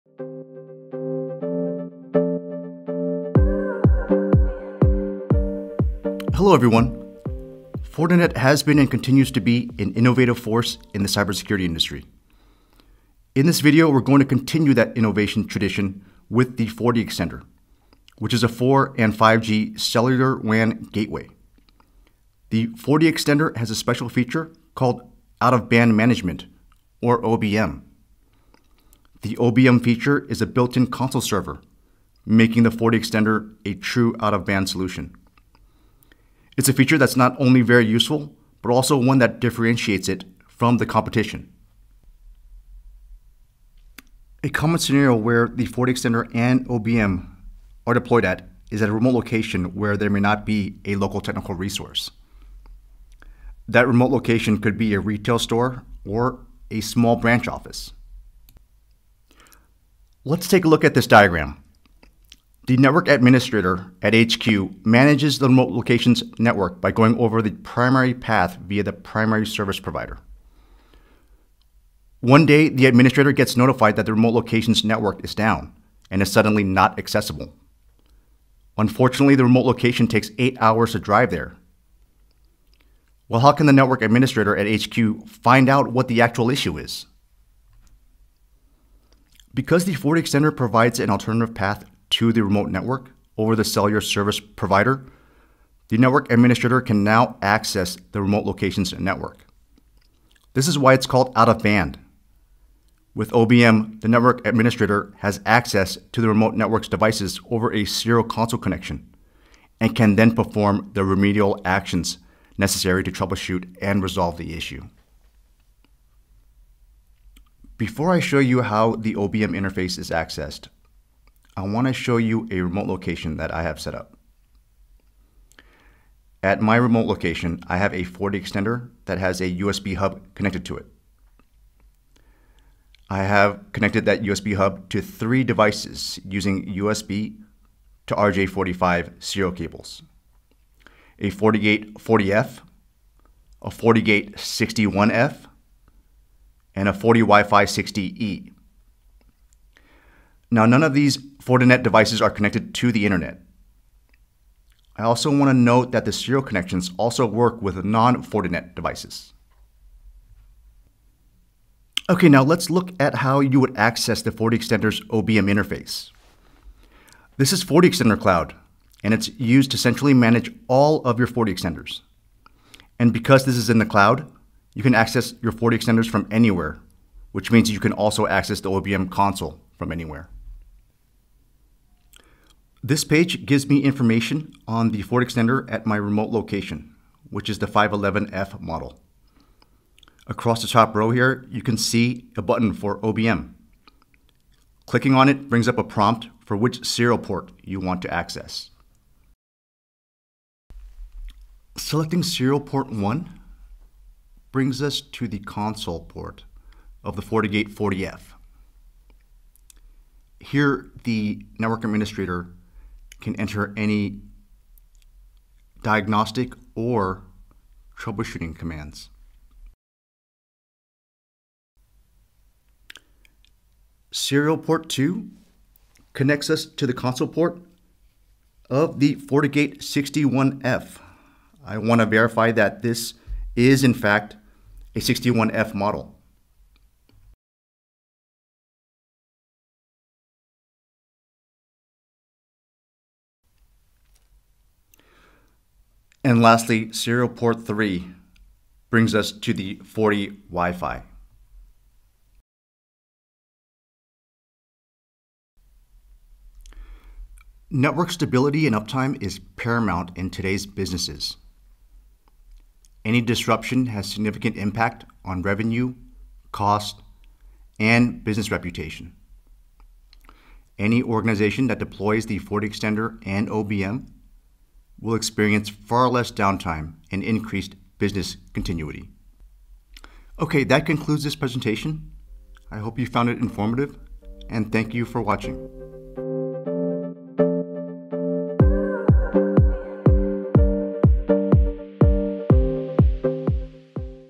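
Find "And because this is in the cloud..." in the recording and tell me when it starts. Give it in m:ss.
2:52.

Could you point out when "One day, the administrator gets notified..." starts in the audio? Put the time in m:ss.
1:12.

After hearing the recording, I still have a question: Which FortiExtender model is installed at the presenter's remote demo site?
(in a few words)
511F.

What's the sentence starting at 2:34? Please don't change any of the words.
I also want to note that the serial connections also work with non-Fortinet devices.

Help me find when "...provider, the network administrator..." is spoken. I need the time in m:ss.
1:34.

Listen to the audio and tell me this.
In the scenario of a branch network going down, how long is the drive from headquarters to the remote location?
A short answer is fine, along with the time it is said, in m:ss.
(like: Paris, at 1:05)
8 hours, at 1:20.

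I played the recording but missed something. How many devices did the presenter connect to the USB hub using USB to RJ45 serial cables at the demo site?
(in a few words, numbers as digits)
3.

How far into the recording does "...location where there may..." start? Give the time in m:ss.
0:49.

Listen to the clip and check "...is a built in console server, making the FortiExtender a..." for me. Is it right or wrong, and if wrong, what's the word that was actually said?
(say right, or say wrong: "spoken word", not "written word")
right.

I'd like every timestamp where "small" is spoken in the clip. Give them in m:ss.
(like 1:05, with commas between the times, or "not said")
0:56.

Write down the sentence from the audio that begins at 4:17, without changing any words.
Network stability and uptime is paramount in today's businesses.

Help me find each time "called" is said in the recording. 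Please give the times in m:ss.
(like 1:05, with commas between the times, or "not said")
0:24, 1:41.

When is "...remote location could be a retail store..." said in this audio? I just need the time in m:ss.
0:53.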